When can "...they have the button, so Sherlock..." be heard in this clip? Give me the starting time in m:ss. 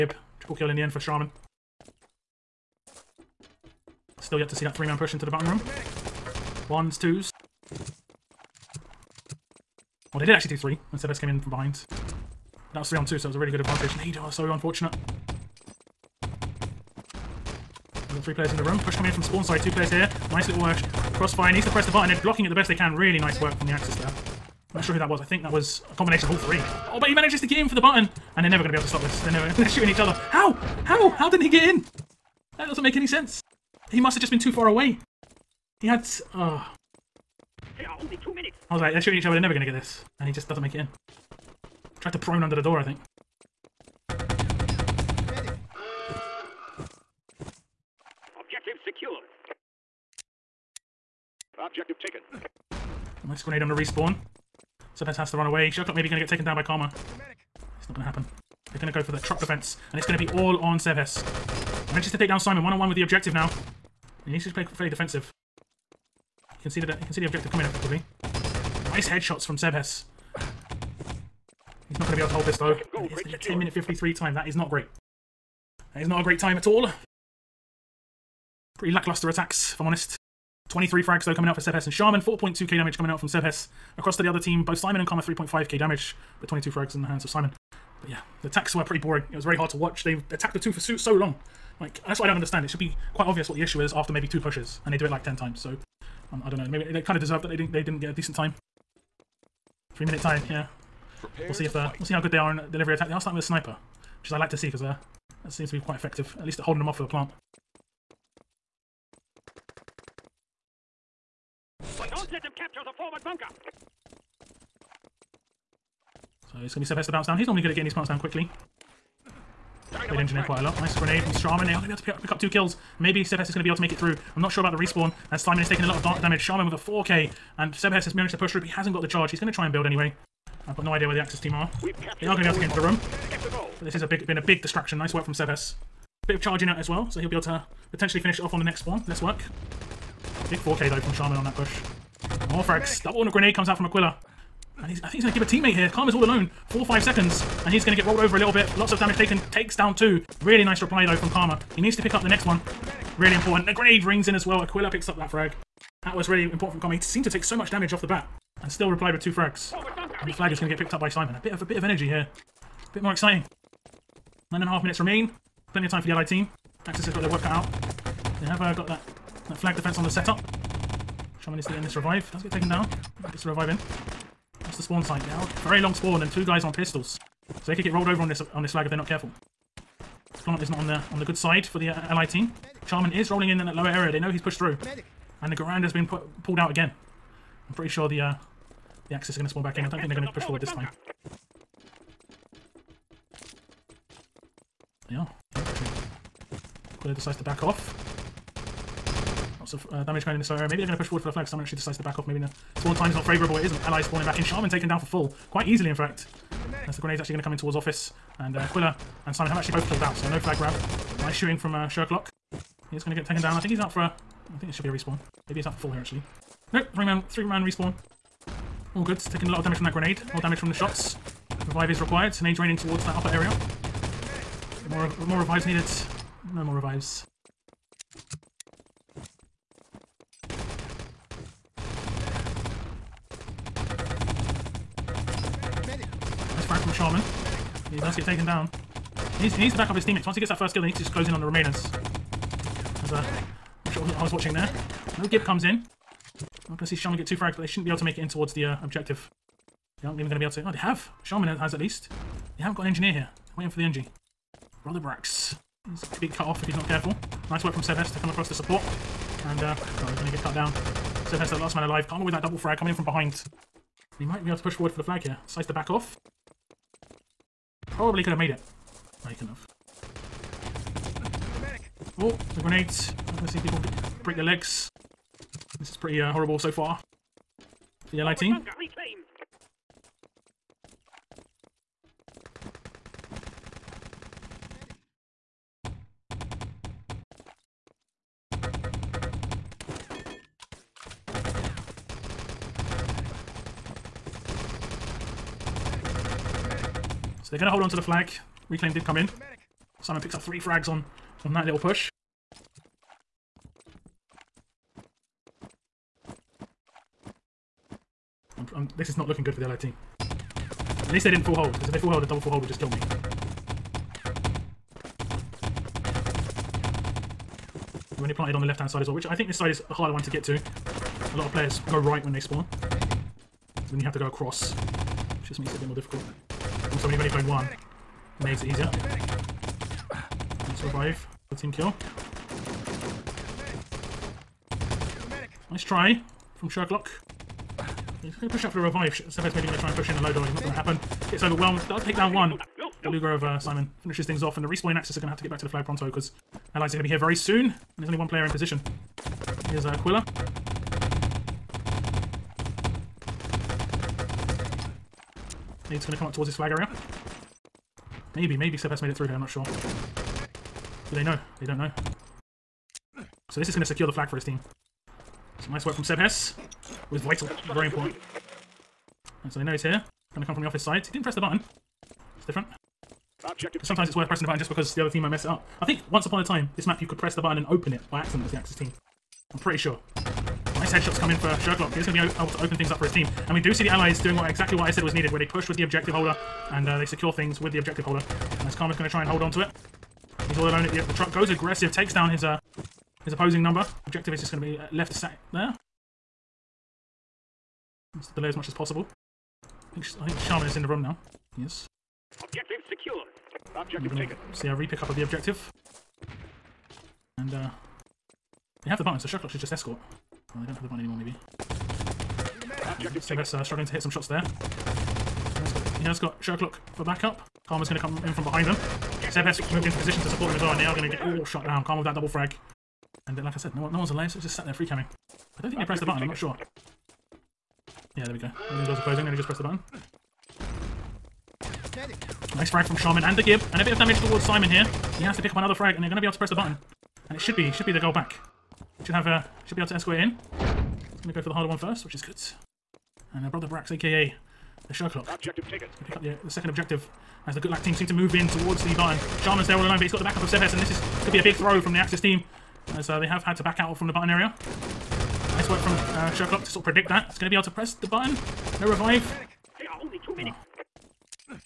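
6:48.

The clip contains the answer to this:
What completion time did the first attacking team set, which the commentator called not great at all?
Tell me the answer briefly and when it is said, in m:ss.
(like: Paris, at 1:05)
10:53, at 1:13.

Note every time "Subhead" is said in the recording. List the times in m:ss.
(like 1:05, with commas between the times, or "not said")
0:54.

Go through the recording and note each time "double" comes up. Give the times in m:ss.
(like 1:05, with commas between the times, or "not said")
2:23, 4:22, 5:12, 7:02.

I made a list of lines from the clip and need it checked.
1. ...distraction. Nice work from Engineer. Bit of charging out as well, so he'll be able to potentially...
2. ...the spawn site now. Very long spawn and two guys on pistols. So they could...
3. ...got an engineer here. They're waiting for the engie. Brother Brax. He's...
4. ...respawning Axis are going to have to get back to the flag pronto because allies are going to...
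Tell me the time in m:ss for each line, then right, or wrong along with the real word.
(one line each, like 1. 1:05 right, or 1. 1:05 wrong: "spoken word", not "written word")
1. 2:14 wrong: "Sebes", not "Engineer"
2. 2:54 right
3. 4:12 right
4. 5:44 right.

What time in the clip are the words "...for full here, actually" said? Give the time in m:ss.
3:35.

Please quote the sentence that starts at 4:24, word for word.
We might be able to push forward for the flag here.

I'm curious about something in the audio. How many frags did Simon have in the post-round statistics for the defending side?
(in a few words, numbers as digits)
22.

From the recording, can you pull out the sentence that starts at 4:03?
As, uh, I'm sure I was watching there.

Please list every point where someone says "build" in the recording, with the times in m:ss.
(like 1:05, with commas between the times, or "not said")
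2:09.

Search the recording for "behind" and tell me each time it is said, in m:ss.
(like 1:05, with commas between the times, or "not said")
0:11, 4:23, 6:58.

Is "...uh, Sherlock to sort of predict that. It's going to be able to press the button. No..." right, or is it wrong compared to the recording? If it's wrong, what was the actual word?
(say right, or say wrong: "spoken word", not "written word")
right.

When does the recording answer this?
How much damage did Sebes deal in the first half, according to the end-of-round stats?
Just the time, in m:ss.
1:22.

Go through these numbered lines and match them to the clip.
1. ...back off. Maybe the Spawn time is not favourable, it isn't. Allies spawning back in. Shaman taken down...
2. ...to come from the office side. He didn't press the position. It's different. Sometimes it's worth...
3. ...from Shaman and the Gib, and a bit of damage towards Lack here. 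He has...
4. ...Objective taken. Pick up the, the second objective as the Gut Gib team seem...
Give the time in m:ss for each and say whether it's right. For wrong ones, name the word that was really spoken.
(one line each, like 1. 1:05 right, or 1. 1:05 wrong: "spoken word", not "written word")
1. 3:22 right
2. 6:10 wrong: "button", not "position"
3. 7:12 wrong: "Simon", not "Lack"
4. 7:25 wrong: "Lack", not "Gib".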